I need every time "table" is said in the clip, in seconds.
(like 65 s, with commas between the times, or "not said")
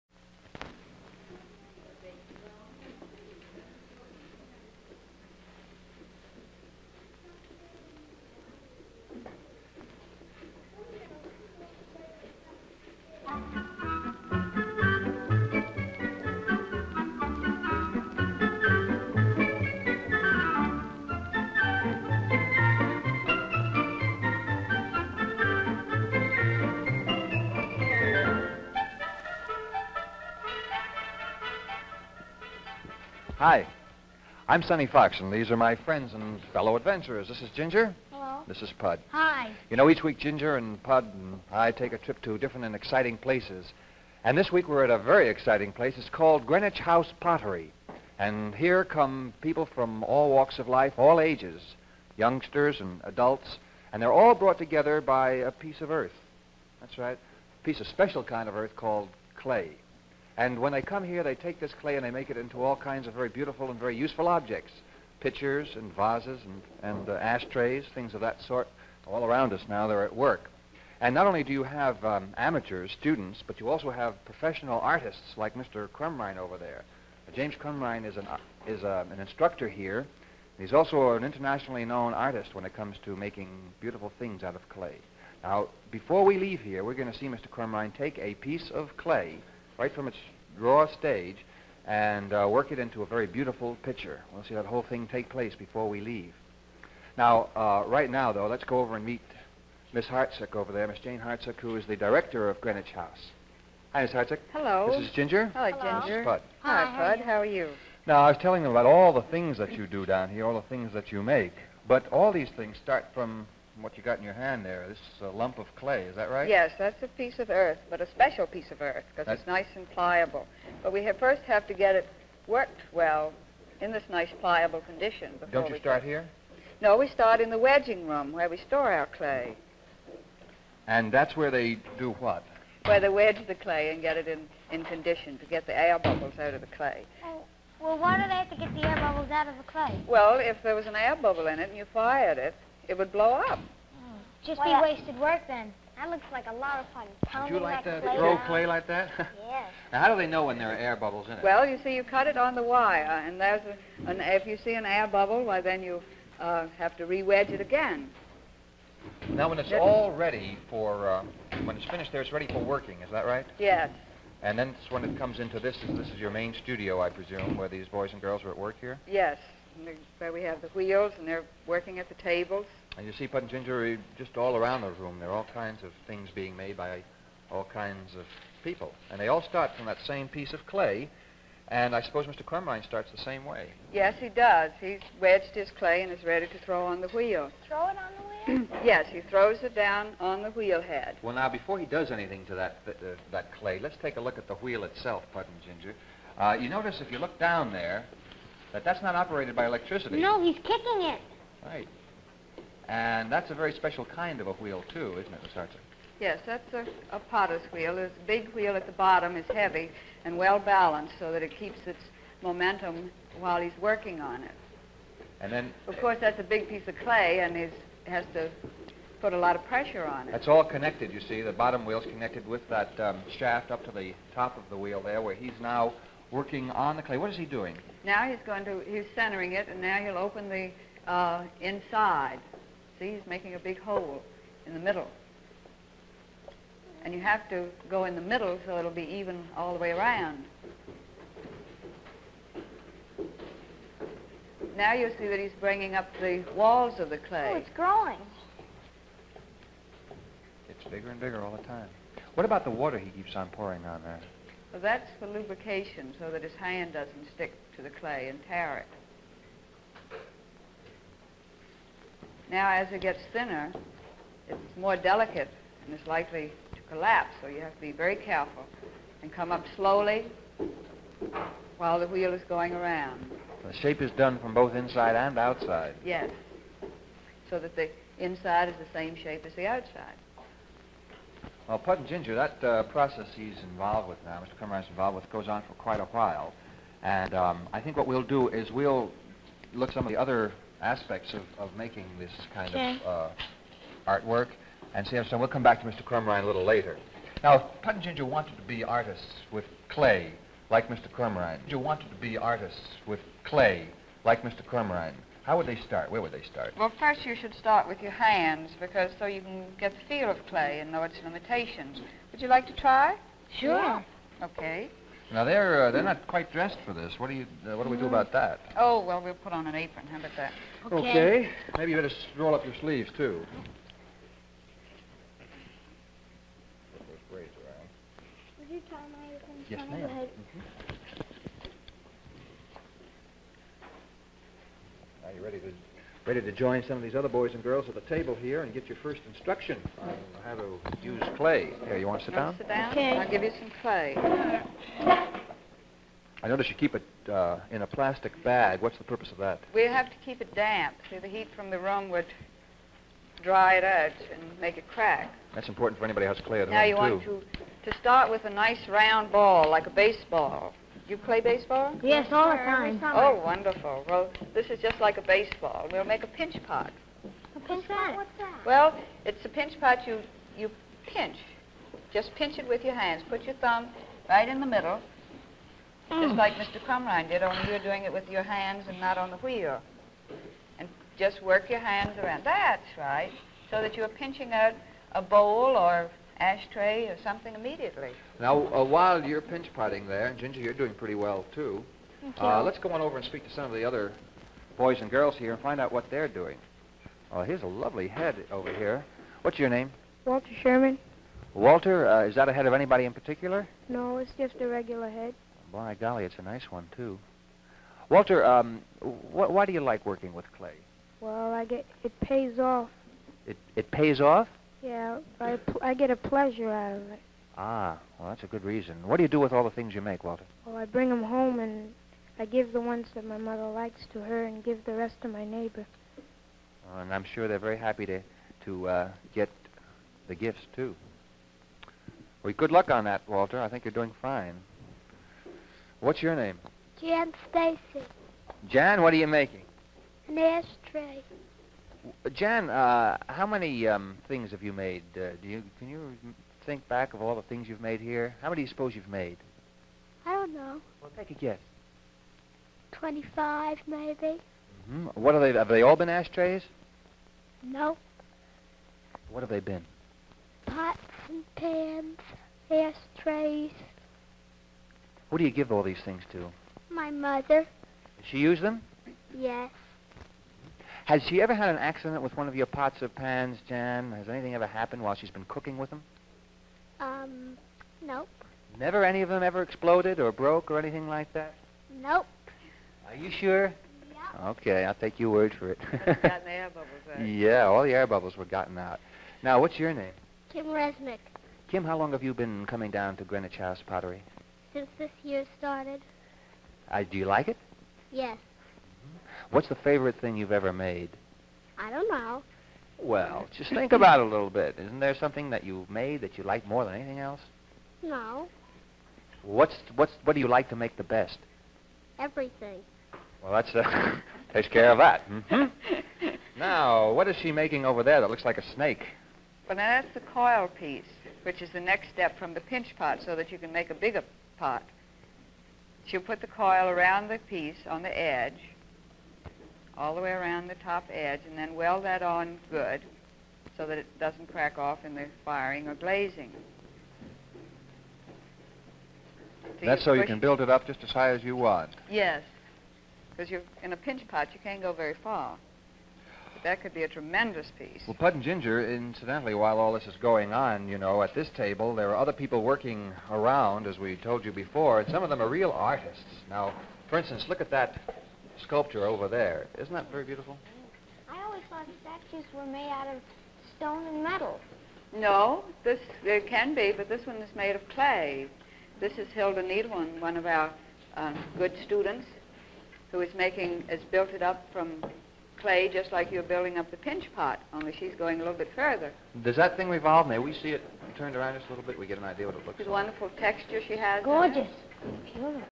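172 s, 338 s, 551 s.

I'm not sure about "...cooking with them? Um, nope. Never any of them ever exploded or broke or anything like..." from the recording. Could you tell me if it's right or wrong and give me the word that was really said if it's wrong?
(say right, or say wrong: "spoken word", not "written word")
right.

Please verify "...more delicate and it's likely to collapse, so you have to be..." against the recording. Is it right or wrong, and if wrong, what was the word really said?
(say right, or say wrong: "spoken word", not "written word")
right.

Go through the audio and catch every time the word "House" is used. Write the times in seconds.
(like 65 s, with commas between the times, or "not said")
46 s, 102 s, 493 s.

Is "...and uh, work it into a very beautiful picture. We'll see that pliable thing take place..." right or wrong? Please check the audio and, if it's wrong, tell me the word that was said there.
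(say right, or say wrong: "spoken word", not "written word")
wrong: "whole", not "pliable".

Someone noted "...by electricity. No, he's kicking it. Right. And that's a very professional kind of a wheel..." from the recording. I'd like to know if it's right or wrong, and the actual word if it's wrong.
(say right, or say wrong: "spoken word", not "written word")
wrong: "special", not "professional".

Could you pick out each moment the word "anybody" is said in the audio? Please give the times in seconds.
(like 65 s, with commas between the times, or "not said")
356 s, 402 s.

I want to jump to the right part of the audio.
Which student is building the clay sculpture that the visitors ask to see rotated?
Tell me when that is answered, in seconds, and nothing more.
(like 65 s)
569 s.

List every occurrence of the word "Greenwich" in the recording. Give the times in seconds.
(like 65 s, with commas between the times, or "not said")
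46 s, 102 s, 493 s.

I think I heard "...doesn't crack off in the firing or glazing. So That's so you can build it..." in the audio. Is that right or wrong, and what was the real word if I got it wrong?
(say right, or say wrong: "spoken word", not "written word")
right.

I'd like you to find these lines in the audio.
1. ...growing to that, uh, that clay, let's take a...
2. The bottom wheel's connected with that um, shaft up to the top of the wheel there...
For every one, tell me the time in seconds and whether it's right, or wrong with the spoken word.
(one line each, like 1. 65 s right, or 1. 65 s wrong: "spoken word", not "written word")
1. 192 s wrong: "anything", not "growing"
2. 221 s right.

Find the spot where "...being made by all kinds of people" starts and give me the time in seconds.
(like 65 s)
176 s.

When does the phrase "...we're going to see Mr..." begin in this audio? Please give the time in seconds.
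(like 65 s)
86 s.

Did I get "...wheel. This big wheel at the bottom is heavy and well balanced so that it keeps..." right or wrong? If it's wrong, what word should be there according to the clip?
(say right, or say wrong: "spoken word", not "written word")
right.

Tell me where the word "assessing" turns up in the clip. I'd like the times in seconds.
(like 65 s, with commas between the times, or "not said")
not said.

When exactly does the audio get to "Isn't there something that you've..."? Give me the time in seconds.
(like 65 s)
504 s.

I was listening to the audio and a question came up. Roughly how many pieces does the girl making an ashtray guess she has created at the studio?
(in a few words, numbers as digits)
25.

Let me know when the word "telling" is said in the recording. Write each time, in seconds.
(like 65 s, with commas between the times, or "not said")
108 s.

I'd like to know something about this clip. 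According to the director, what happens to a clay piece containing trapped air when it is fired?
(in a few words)
It would blow up.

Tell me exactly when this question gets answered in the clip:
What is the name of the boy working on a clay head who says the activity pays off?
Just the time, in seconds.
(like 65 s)
400 s.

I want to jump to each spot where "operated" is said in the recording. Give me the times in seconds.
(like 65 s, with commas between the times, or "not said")
199 s.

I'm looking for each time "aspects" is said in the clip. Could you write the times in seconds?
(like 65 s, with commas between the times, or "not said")
290 s.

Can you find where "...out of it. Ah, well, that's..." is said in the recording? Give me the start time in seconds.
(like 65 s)
416 s.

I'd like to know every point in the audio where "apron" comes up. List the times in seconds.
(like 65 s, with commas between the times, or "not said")
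319 s, 329 s.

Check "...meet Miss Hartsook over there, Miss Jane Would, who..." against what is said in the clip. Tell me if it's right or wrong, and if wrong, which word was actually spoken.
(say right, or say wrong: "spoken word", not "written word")
wrong: "Hartsook", not "Would".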